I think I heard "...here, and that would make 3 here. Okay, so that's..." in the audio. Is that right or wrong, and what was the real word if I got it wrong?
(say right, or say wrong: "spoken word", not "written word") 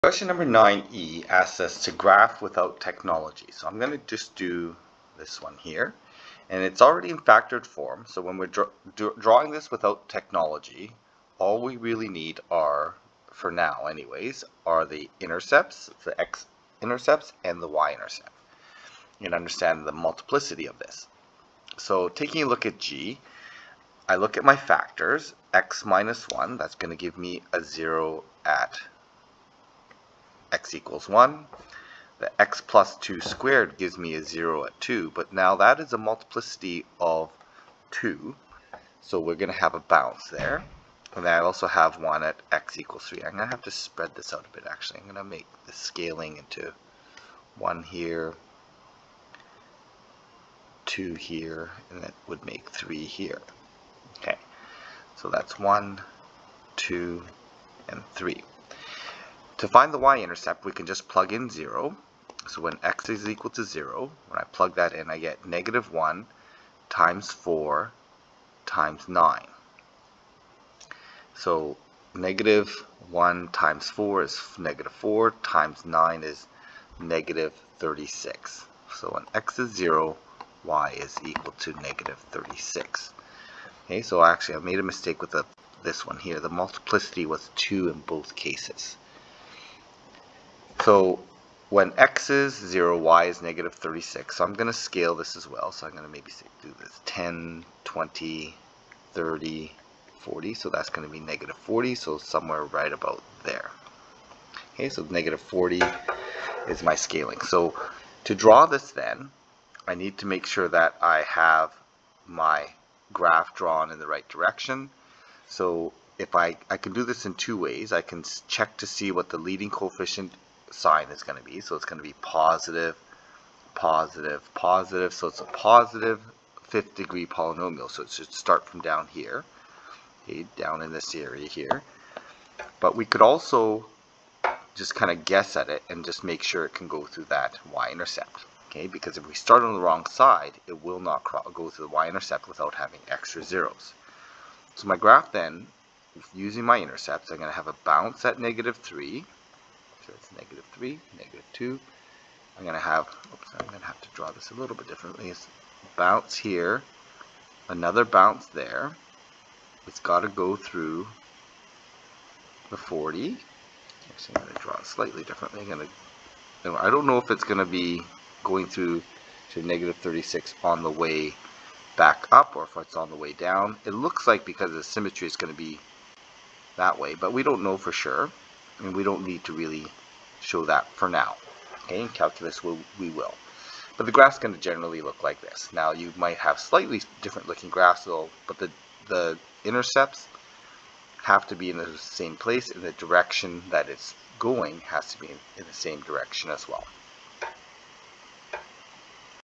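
right.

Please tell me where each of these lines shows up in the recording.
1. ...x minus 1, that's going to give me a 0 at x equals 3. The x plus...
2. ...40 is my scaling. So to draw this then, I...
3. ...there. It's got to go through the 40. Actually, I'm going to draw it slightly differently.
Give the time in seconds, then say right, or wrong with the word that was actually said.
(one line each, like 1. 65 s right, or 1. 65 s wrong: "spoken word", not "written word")
1. 25 s wrong: "1", not "3"
2. 105 s right
3. 158 s right.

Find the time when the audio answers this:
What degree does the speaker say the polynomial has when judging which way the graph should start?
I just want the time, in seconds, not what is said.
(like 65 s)
126 s.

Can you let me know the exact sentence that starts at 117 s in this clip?
I can check to see what the leading coefficient sign is going to be.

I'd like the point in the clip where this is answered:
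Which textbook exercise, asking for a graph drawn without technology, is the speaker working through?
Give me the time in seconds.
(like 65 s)
0 s.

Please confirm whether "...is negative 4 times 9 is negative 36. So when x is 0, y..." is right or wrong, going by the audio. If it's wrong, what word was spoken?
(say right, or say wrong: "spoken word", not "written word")
right.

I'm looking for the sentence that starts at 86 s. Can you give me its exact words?
The multiplicity was 2 in both cases.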